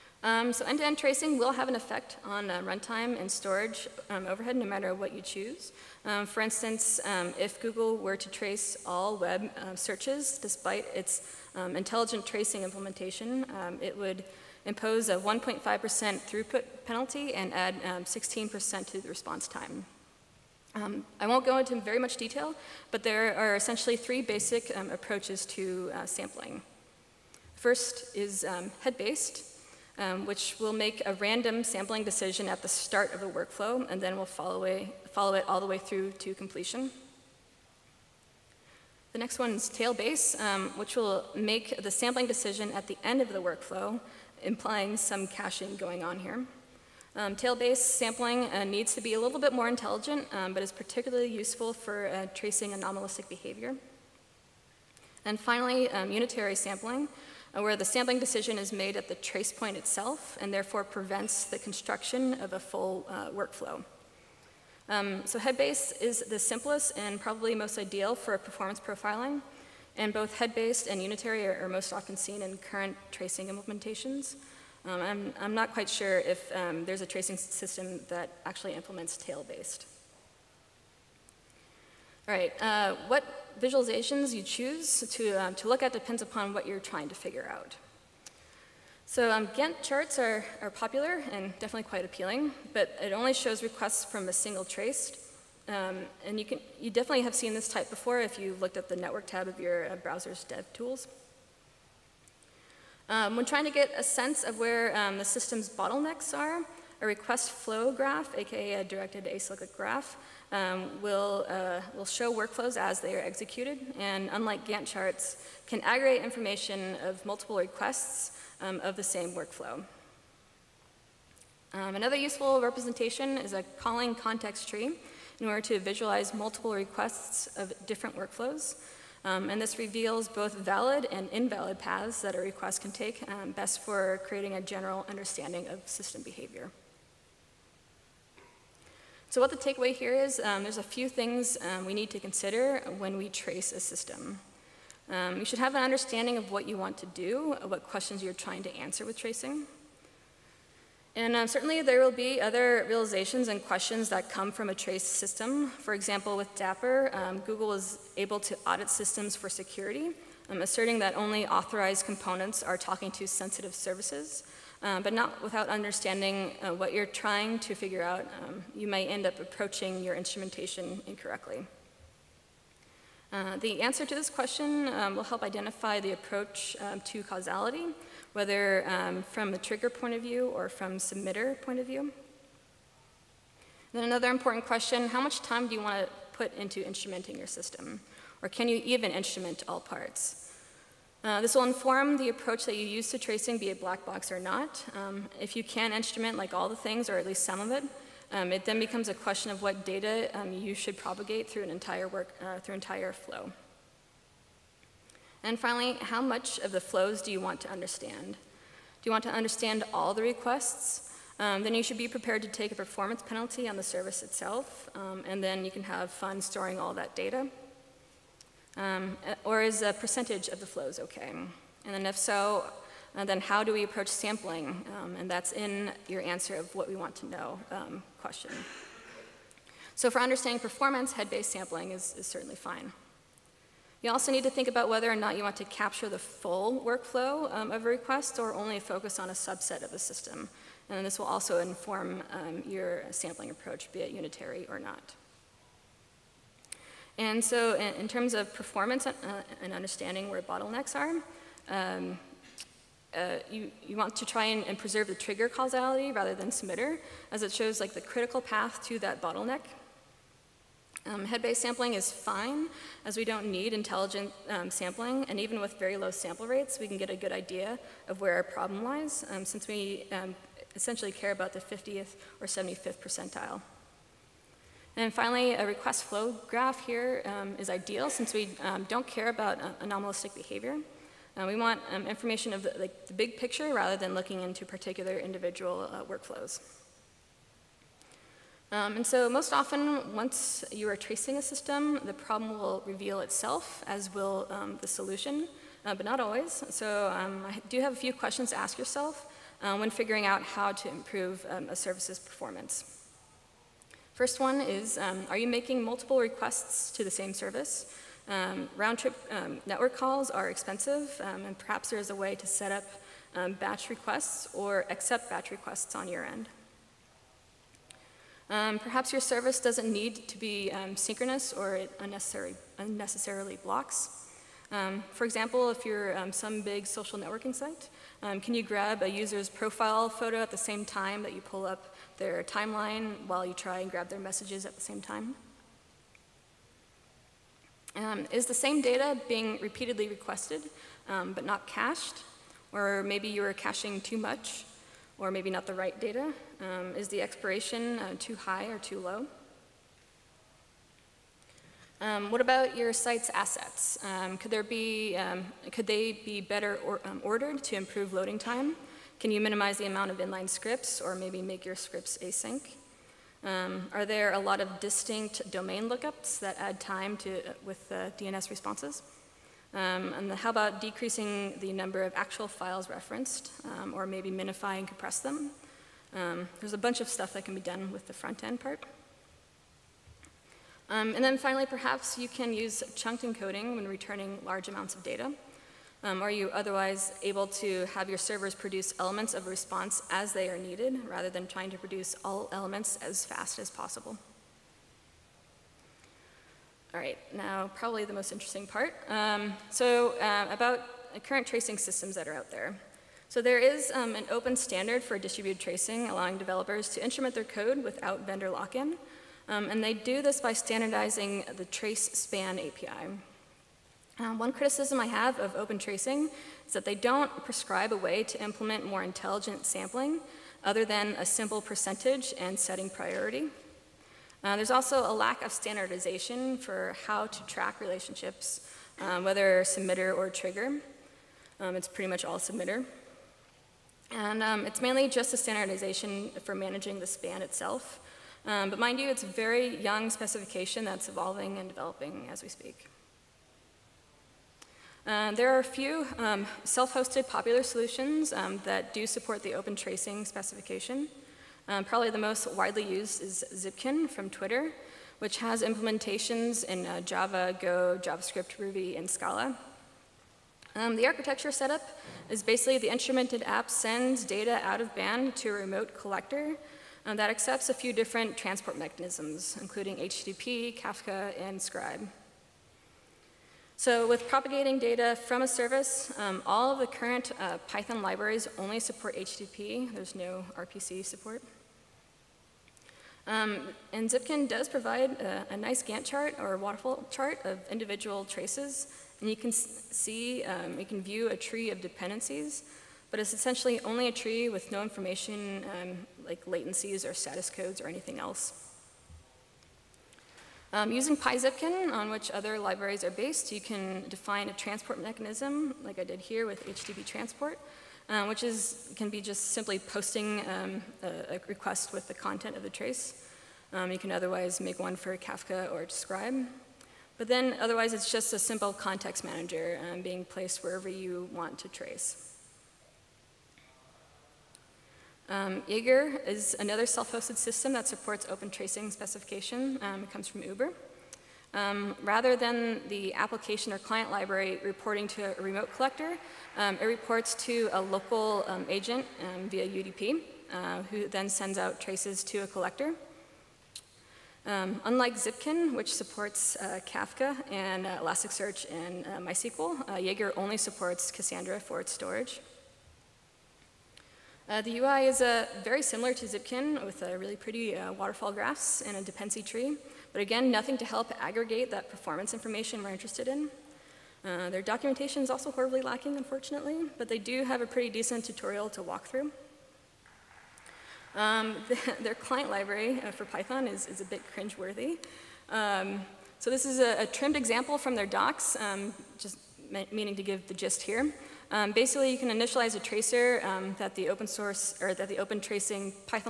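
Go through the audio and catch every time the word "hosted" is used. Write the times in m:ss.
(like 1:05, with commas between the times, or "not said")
7:26, 8:46.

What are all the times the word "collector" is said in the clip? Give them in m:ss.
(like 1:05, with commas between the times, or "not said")
7:45, 8:55, 9:02.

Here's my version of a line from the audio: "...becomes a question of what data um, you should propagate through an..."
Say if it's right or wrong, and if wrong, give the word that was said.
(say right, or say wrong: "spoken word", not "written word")
right.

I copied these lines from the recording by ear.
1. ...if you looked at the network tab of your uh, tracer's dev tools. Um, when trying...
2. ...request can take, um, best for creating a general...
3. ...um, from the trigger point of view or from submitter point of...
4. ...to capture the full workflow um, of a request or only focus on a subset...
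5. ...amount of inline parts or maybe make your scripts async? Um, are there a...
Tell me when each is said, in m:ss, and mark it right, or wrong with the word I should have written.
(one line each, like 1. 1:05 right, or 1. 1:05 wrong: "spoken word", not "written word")
1. 1:38 wrong: "browser", not "tracer"
2. 2:12 right
3. 2:58 right
4. 3:55 right
5. 5:59 wrong: "scripts", not "parts".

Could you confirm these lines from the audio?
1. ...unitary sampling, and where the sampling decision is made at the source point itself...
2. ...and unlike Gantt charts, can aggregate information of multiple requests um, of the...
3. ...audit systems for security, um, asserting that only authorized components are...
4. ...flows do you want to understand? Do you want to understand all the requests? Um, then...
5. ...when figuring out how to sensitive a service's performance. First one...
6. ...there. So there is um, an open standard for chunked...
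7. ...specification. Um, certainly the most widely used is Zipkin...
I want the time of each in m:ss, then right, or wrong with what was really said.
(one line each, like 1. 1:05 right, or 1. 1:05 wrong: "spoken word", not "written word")
1. 0:56 wrong: "trace", not "source"
2. 1:53 right
3. 2:38 right
4. 3:26 right
5. 4:59 wrong: "improve", not "sensitive"
6. 6:42 wrong: "distributed", not "chunked"
7. 7:30 wrong: "probably", not "certainly".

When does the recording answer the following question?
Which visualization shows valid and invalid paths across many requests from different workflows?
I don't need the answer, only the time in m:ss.
2:03.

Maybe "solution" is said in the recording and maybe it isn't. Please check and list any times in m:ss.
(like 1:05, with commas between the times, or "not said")
4:54, 7:27.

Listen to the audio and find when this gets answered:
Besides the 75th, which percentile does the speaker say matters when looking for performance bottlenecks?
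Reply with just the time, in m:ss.
4:31.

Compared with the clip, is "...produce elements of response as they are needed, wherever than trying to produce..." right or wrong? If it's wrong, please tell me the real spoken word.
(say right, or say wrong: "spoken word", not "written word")
wrong: "rather", not "wherever".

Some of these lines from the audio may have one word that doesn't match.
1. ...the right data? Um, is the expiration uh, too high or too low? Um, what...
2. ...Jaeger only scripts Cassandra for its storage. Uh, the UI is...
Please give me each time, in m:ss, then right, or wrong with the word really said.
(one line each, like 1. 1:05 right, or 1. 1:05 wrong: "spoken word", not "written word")
1. 5:45 right
2. 9:09 wrong: "supports", not "scripts".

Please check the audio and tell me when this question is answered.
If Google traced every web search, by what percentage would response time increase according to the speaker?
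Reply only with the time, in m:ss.
0:18.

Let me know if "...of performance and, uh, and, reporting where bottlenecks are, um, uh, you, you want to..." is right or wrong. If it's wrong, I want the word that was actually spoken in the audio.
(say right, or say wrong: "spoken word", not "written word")
wrong: "understanding", not "reporting".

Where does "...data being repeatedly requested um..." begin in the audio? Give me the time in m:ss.
5:38.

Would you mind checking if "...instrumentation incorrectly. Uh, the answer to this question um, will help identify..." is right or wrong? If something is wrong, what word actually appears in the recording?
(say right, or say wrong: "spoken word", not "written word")
right.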